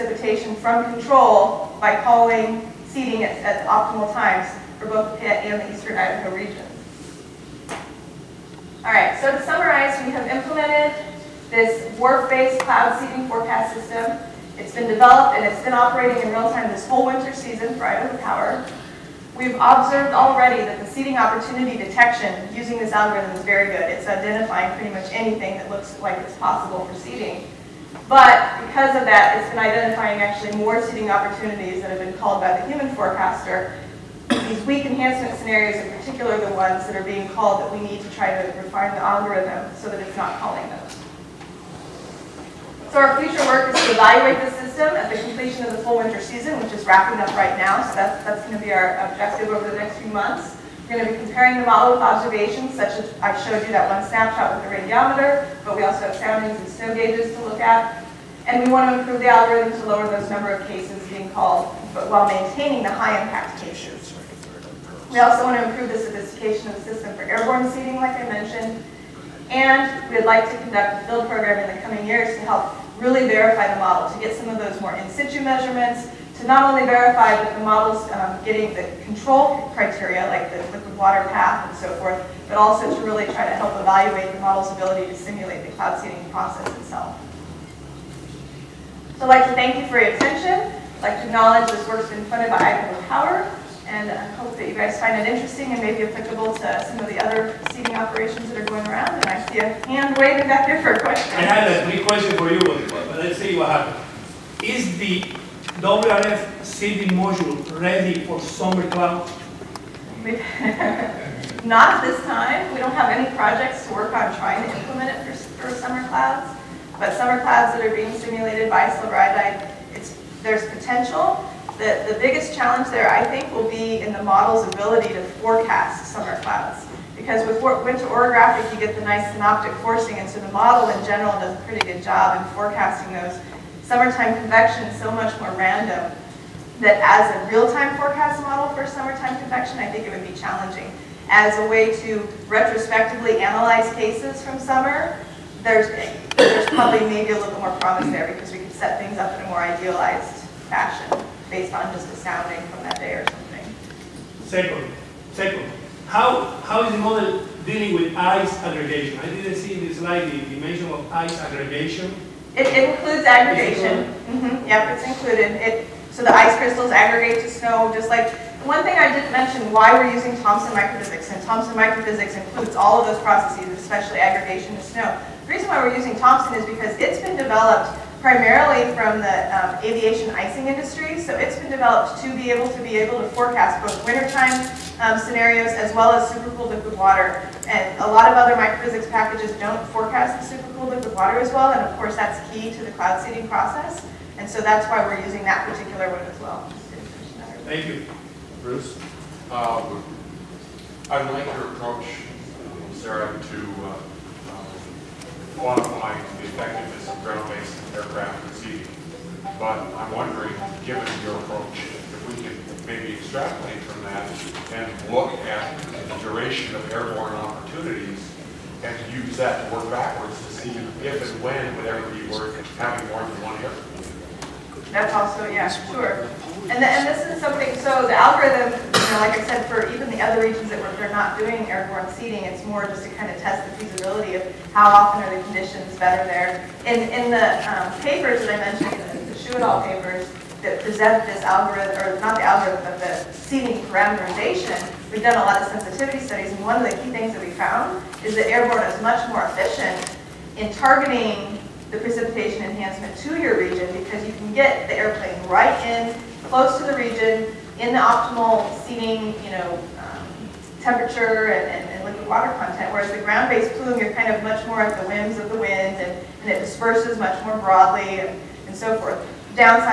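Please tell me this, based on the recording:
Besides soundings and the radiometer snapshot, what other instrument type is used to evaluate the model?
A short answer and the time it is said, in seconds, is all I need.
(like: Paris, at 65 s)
Snow gauges, at 56 s.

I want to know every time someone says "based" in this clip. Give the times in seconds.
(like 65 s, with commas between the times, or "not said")
11 s, 151 s, 207 s, 263 s.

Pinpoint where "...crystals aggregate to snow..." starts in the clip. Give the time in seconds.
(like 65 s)
166 s.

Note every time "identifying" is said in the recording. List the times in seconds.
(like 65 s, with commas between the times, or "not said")
24 s, 29 s.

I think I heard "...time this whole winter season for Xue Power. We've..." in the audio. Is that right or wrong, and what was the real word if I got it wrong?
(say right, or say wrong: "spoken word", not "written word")
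wrong: "Idaho", not "Xue".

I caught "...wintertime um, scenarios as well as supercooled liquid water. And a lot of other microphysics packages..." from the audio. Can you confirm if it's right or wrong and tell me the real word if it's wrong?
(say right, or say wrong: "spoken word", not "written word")
right.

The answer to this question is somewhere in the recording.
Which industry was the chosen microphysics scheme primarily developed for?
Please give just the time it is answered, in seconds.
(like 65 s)
179 s.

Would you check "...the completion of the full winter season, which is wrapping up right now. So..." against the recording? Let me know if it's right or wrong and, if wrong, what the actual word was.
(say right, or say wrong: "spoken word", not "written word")
right.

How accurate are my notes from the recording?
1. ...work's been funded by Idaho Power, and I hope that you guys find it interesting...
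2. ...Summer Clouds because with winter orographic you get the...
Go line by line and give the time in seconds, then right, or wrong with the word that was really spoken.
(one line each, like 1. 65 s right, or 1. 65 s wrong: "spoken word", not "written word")
1. 91 s right
2. 126 s right.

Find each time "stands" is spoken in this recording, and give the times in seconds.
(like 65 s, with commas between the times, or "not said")
not said.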